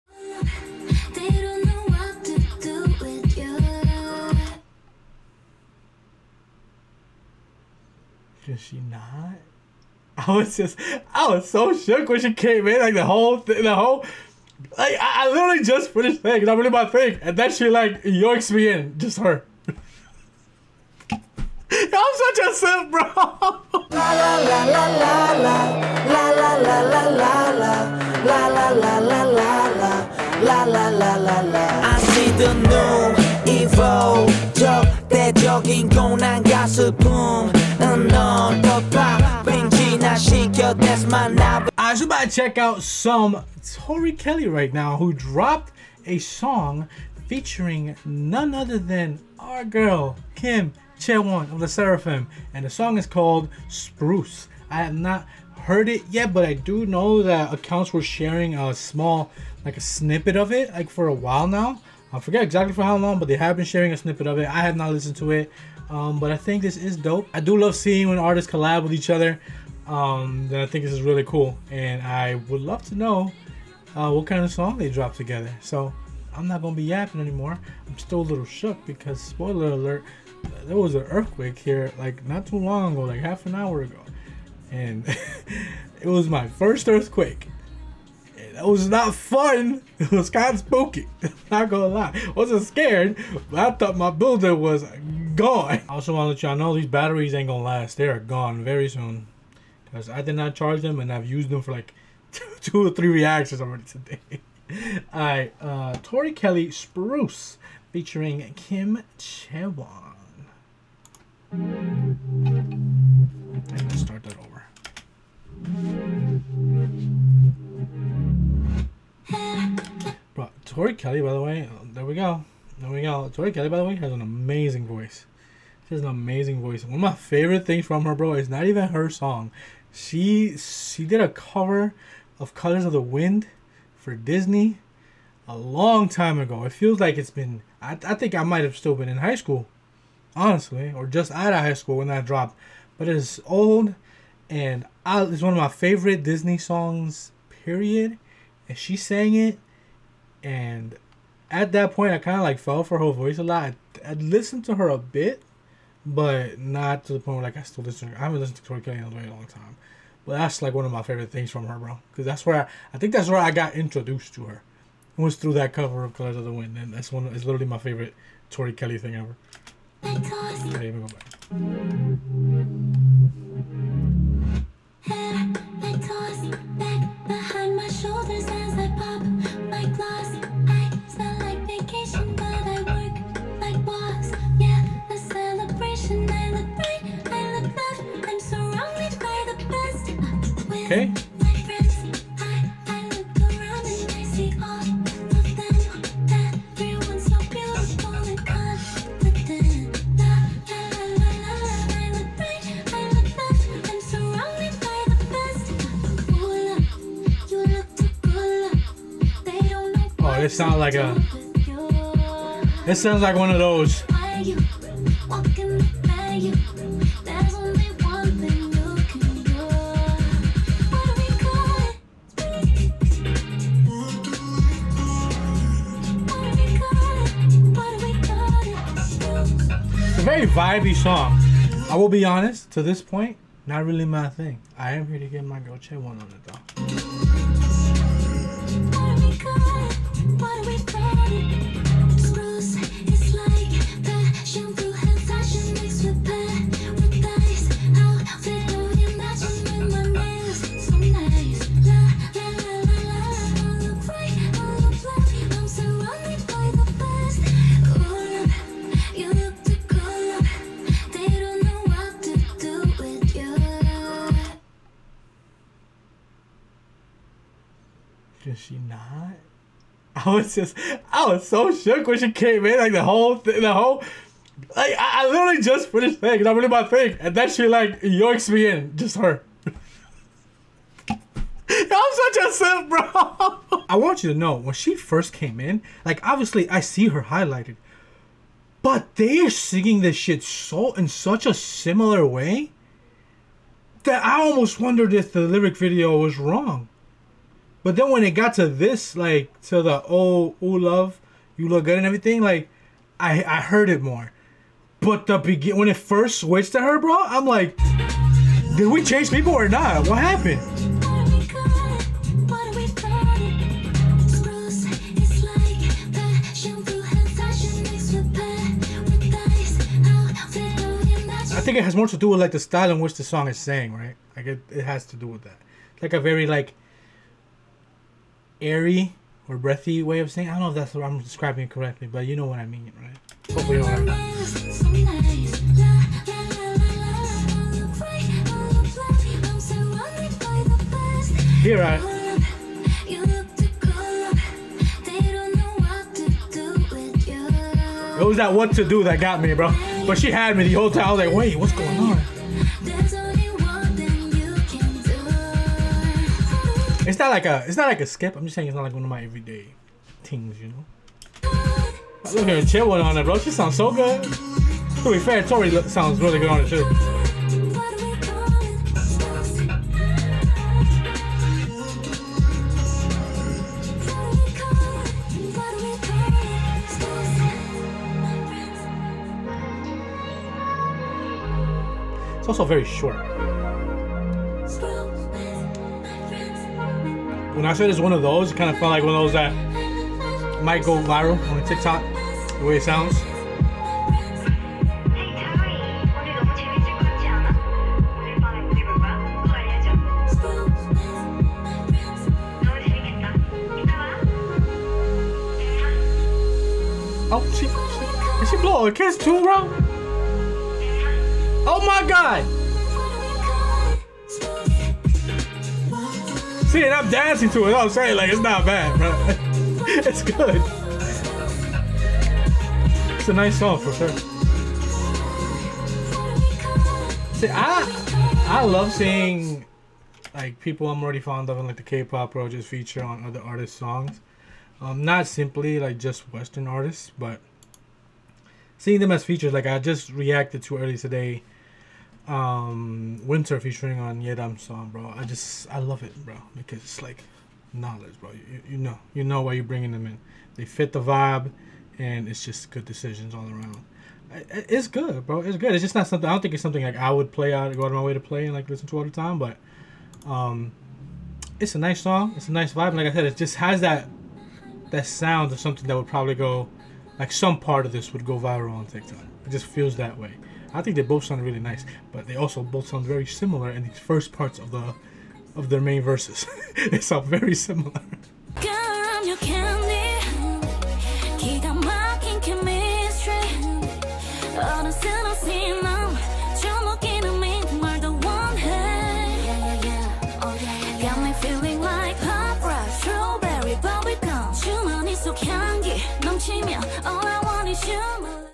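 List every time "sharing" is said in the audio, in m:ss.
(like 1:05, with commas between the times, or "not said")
0:58, 1:03.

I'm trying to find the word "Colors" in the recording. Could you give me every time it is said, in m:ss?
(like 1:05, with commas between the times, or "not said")
2:12, 2:46.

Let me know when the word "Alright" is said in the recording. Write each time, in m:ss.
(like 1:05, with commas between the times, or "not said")
1:45.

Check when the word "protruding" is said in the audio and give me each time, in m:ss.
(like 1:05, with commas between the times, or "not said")
not said.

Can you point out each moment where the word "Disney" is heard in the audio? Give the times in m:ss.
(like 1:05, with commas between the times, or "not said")
2:14, 2:26.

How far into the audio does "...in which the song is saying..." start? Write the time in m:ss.
5:22.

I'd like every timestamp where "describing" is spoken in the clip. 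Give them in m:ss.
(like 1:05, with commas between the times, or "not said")
5:31.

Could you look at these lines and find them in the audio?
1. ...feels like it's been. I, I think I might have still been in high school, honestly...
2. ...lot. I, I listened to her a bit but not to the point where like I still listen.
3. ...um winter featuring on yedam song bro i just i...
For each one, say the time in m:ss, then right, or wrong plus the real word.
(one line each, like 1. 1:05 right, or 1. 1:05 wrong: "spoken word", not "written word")
1. 2:16 right
2. 2:33 right
3. 7:22 right.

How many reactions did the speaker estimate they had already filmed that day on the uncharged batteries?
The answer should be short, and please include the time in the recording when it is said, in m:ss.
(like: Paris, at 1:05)
2 or 3, at 1:42.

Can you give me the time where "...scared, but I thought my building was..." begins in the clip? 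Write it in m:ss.
1:32.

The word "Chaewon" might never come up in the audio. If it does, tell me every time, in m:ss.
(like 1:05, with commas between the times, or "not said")
0:50, 1:49.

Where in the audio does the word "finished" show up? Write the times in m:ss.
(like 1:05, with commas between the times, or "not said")
4:35.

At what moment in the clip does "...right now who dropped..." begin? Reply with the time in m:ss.
0:44.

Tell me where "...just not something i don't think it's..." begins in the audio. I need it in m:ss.
7:35.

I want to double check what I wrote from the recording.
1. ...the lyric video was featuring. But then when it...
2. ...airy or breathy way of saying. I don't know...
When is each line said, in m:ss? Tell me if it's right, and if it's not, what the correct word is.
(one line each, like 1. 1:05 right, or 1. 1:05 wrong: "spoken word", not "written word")
1. 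4:55 wrong: "wrong", not "featuring"
2. 5:28 right.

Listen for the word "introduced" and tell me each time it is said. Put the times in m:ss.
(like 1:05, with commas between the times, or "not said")
2:43.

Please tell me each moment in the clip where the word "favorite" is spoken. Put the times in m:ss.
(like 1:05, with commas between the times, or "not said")
2:07, 2:25, 2:41, 2:47.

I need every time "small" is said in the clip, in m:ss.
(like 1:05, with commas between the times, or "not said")
0:58.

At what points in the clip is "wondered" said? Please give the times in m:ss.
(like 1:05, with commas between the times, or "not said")
4:54.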